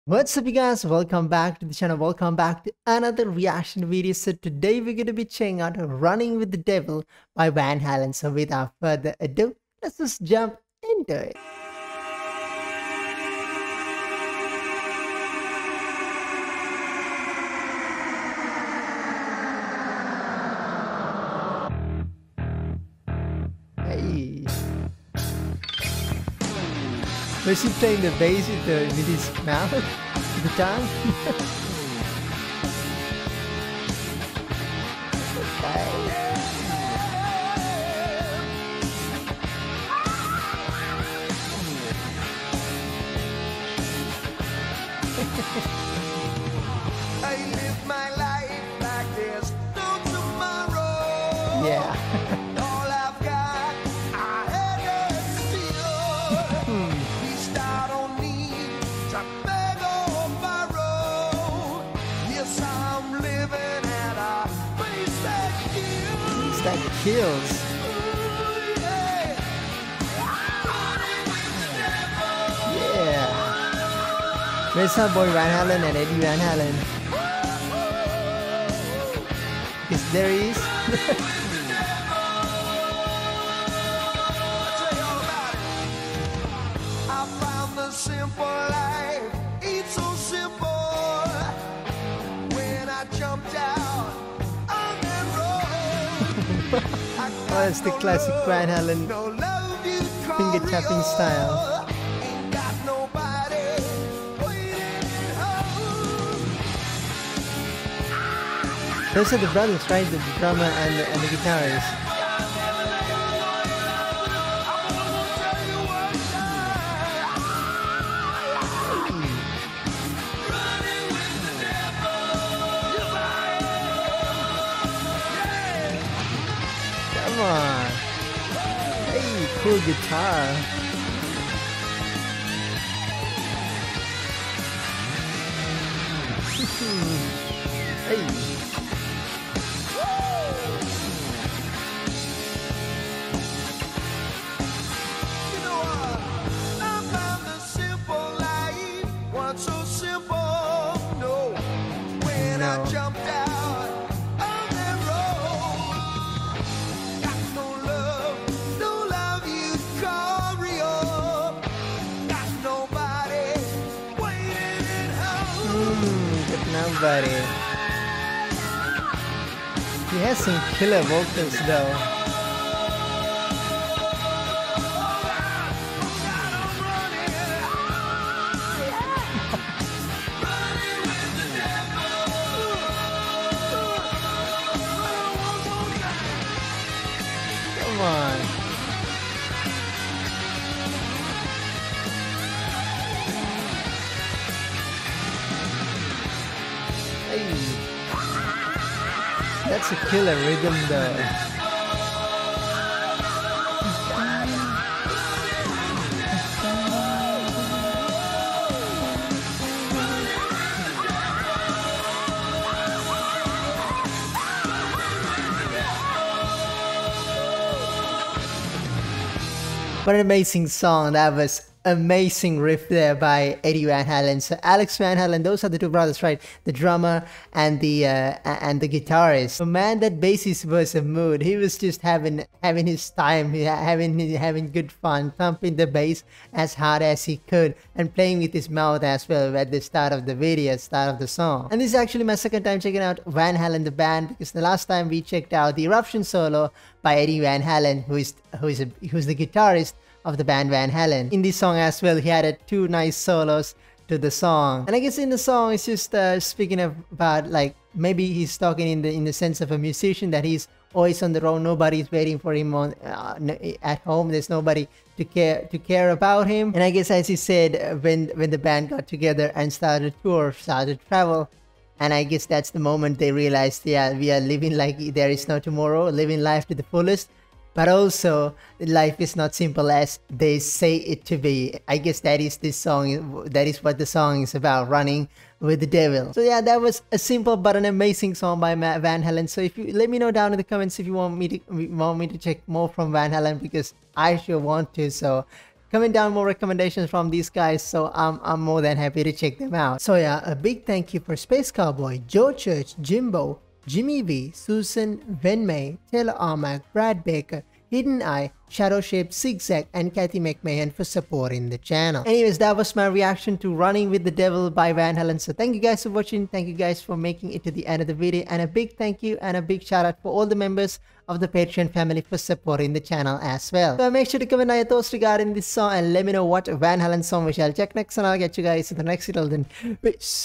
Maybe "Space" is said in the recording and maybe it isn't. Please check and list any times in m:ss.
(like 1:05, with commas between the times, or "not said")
5:01.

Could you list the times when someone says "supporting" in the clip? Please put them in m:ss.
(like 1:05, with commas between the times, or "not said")
5:11, 5:22.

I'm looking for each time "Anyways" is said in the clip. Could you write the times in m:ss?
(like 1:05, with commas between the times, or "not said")
5:12.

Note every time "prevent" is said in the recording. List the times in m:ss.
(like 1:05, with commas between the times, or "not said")
not said.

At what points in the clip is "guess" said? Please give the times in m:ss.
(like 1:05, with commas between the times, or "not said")
4:14, 4:26, 4:32, 4:41.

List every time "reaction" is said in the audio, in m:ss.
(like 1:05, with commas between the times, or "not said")
0:03, 5:13.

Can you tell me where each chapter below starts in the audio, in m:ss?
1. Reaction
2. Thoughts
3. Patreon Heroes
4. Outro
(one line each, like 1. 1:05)
1. 0:10
2. 3:39
3. 4:59
4. 5:23.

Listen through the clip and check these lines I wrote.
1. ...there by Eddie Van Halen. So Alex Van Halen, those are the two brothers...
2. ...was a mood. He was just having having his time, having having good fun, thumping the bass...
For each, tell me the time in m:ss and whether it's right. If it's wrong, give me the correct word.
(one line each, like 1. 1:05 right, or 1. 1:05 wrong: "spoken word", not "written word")
1. 3:42 right
2. 3:50 right.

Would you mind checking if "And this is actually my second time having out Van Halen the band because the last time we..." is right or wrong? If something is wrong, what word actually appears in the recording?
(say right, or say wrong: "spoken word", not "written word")
wrong: "checking", not "having".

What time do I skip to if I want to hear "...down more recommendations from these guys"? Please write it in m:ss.
4:56.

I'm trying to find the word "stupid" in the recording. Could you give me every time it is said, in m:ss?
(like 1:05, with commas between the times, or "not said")
not said.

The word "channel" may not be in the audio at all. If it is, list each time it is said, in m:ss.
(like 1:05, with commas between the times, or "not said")
0:01, 5:11, 5:23.